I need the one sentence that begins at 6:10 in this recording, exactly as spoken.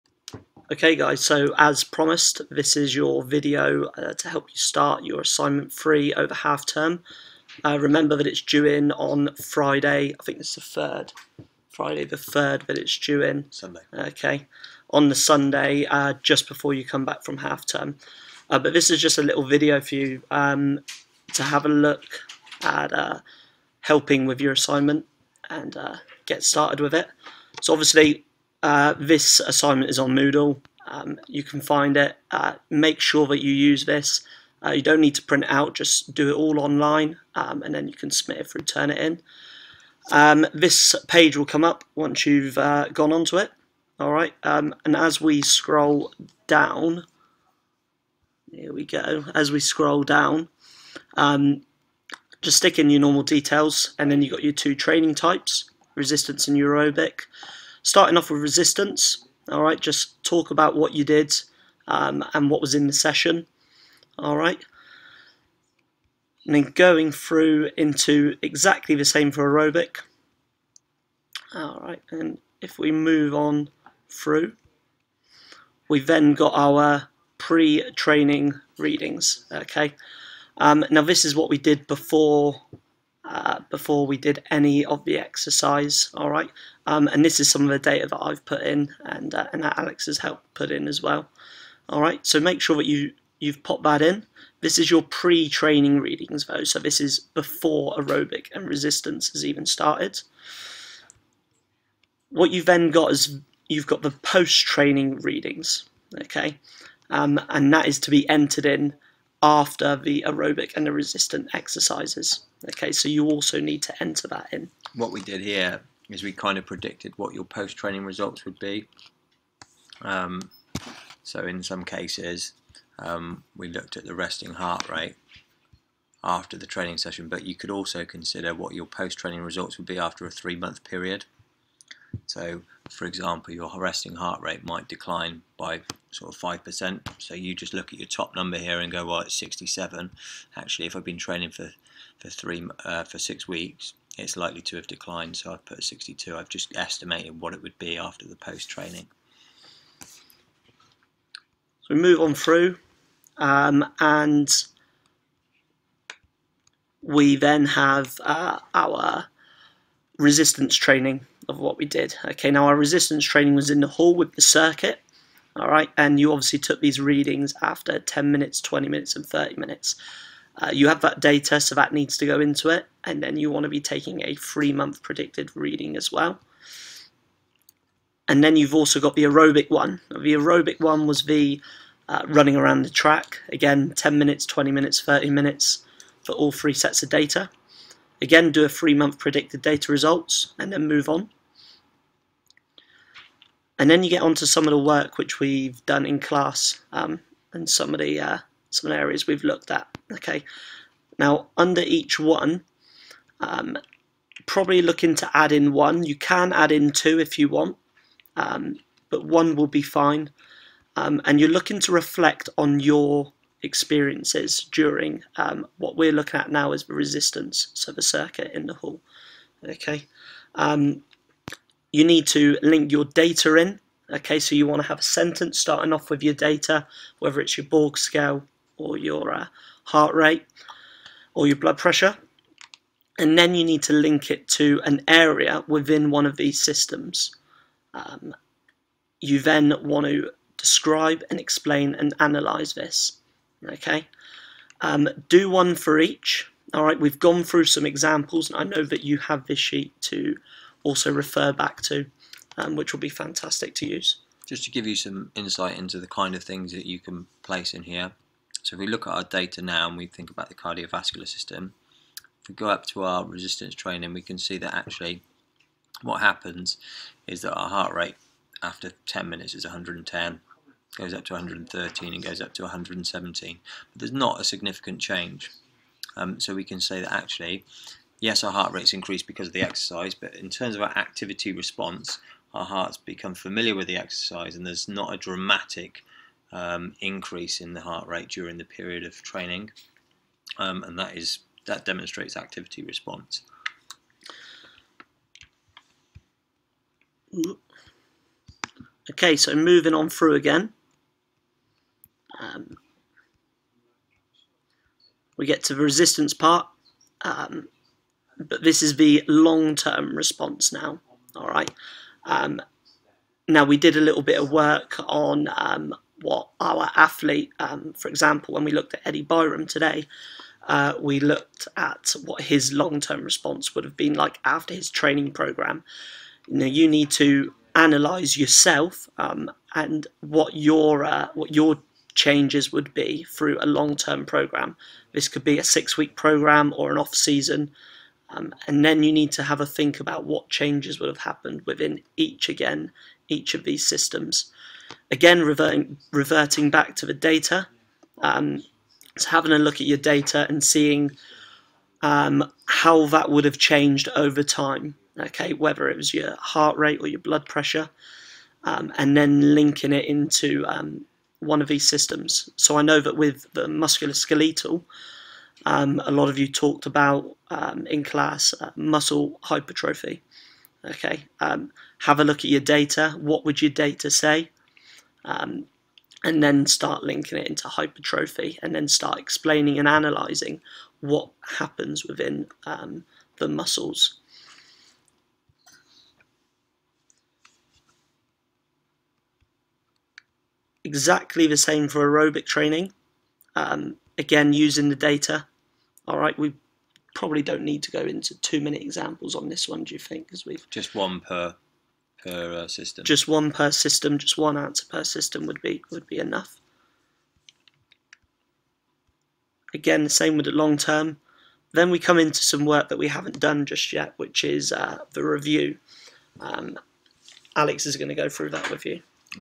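Okay, um, have a look at your data.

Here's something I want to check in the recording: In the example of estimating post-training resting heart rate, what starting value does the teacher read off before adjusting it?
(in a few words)
67.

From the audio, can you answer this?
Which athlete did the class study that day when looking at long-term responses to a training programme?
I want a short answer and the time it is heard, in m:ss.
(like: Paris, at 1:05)
Eddie Byram, at 5:19.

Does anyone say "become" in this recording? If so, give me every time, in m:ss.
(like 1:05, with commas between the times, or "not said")
4:42.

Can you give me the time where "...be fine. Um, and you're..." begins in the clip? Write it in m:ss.
3:29.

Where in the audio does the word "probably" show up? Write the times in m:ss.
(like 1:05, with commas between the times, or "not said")
3:24, 6:37.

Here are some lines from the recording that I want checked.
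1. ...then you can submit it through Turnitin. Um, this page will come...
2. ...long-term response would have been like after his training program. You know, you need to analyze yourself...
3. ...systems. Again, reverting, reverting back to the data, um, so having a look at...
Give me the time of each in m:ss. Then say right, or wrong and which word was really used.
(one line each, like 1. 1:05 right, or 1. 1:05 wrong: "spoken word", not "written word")
1. 0:37 right
2. 5:22 right
3. 5:43 right.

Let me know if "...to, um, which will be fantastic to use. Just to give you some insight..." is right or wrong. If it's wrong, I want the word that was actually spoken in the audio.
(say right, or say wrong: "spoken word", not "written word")
right.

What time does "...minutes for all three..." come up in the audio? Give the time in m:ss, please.
3:05.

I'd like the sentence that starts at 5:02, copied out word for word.
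Um, we get to the resistance part.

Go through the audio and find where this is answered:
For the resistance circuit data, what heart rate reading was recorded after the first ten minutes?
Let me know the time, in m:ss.
4:29.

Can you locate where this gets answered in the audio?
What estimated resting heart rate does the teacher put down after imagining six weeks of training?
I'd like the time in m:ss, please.
2:25.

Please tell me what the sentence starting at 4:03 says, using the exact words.
Okay, um, do one for each.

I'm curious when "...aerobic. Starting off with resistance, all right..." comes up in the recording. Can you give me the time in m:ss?
0:56.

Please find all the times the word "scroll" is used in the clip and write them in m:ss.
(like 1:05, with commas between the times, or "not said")
0:45, 0:49.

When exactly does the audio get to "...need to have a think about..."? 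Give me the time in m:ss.
5:39.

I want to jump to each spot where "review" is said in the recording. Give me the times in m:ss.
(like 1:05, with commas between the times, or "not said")
6:55.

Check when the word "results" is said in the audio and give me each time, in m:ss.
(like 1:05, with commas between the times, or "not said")
1:58, 2:09, 3:09.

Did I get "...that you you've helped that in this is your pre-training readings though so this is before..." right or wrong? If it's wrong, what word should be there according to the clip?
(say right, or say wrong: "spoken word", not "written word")
wrong: "popped", not "helped".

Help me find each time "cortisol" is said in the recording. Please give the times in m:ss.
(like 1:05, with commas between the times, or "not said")
not said.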